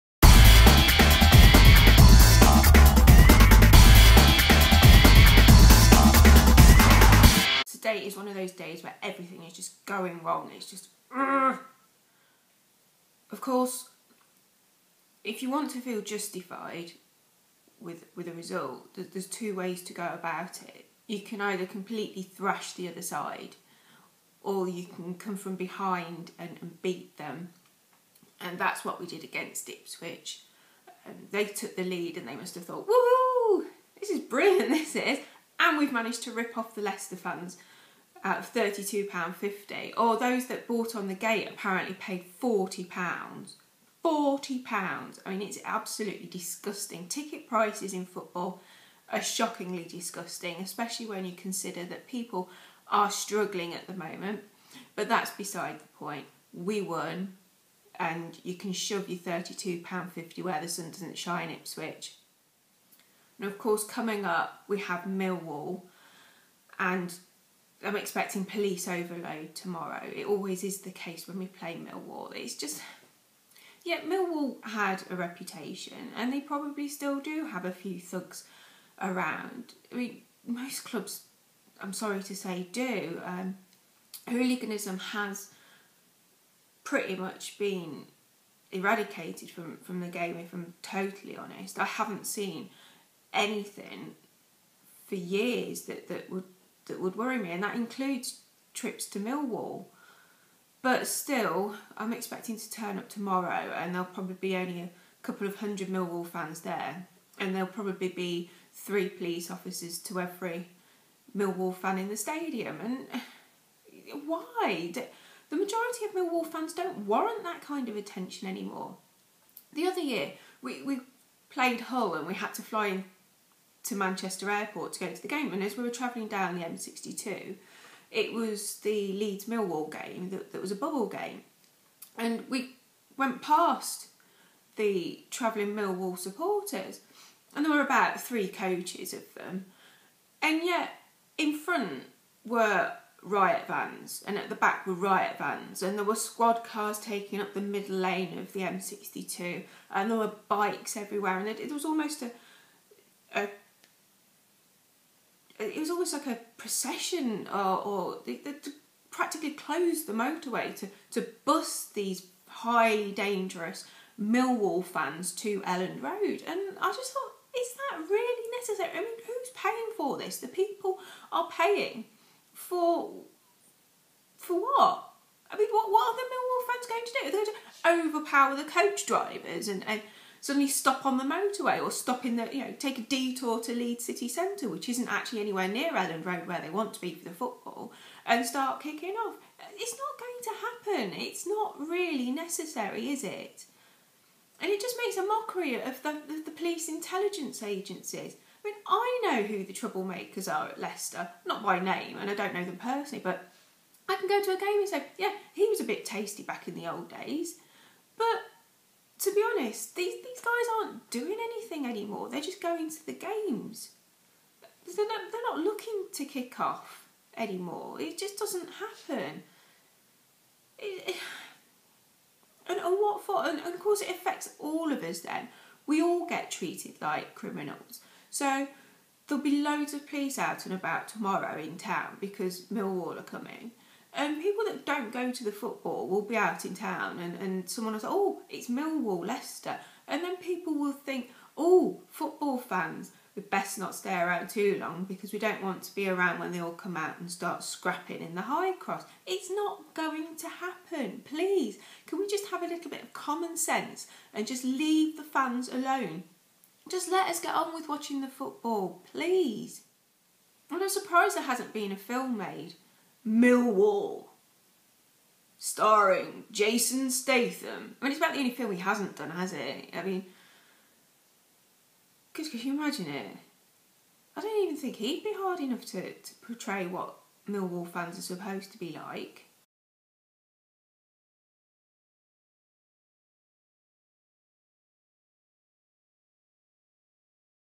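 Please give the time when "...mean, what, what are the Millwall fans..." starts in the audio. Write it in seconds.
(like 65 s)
175 s.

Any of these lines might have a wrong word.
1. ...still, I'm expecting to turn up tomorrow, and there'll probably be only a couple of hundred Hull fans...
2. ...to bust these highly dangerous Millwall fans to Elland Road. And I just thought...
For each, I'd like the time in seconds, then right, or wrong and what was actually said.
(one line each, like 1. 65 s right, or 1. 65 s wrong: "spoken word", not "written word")
1. 101 s wrong: "Millwall", not "Hull"
2. 161 s right.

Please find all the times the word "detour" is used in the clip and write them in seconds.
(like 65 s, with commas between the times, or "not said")
183 s.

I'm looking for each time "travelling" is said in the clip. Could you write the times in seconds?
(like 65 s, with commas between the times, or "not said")
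125 s, 135 s.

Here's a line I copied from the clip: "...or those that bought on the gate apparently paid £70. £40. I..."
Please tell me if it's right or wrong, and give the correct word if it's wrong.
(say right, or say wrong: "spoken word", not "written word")
wrong: "40", not "70".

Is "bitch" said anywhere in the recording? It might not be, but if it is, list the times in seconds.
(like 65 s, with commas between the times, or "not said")
not said.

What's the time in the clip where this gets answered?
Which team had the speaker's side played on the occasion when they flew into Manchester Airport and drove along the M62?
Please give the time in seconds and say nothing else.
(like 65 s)
121 s.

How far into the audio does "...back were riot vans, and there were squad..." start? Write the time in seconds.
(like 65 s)
144 s.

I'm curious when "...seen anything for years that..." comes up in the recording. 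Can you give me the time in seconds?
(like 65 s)
92 s.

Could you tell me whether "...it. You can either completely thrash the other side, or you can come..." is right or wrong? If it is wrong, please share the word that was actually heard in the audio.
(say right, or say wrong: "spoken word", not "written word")
right.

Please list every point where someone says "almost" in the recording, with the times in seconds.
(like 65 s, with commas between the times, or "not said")
151 s, 155 s.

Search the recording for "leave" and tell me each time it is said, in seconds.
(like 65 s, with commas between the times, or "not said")
254 s.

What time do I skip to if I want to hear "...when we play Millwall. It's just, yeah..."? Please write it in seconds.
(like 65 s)
71 s.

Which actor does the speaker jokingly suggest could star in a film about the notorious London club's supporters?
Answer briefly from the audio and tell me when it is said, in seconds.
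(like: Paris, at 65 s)
Jason Statham, at 266 s.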